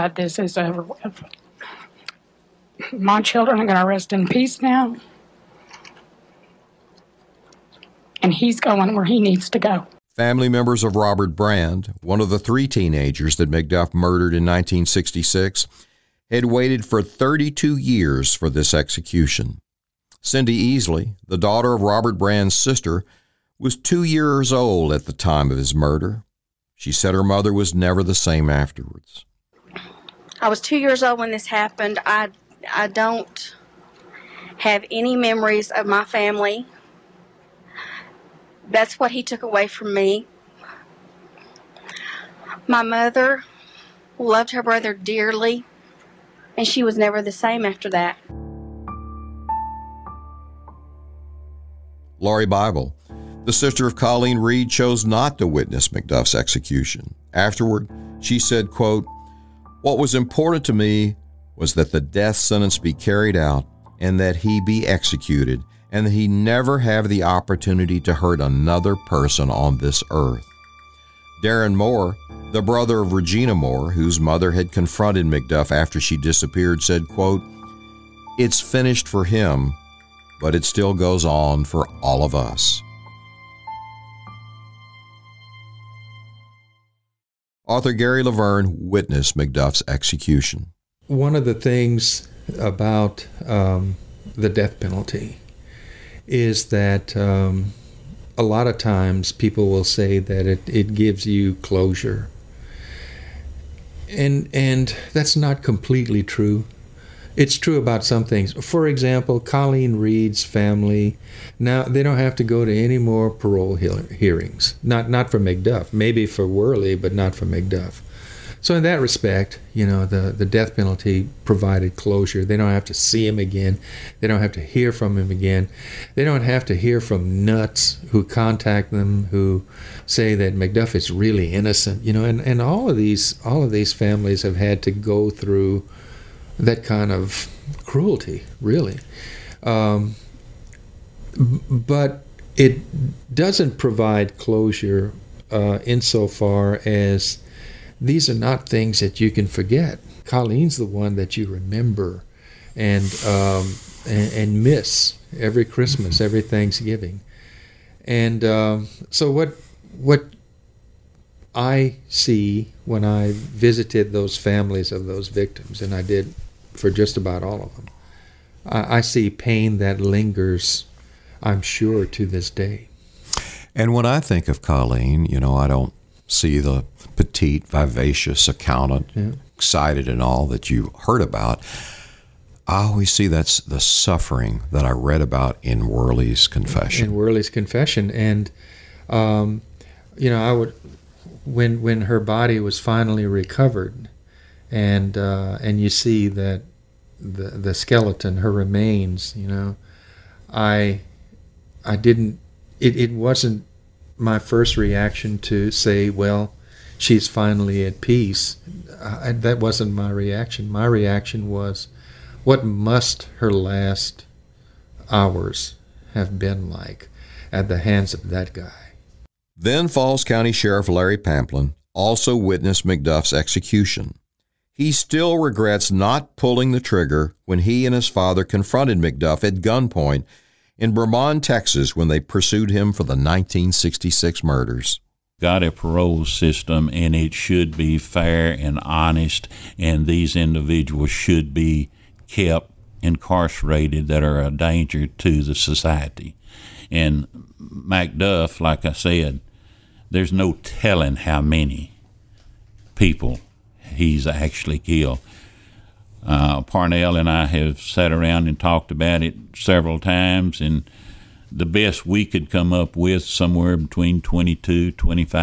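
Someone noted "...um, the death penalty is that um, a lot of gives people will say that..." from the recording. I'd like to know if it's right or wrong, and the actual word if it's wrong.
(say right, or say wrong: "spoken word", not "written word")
wrong: "times", not "gives".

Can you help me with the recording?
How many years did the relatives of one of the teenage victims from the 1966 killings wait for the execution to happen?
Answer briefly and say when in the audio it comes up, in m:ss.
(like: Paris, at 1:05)
32, at 0:17.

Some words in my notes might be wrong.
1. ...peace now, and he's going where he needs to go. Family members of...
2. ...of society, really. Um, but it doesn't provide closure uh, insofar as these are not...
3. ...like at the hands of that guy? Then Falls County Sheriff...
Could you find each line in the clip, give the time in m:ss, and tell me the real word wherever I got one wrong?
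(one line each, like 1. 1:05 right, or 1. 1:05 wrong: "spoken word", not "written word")
1. 0:04 right
2. 2:17 wrong: "cruelty", not "society"
3. 3:36 right.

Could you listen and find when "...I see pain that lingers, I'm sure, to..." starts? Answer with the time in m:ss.
2:48.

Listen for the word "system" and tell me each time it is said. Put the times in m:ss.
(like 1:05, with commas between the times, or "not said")
3:56.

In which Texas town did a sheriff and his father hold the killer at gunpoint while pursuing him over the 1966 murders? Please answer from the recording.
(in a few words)
Bremond, Texas.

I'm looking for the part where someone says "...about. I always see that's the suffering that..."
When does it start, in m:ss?
3:01.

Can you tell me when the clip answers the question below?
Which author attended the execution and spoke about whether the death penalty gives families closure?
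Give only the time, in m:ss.
1:27.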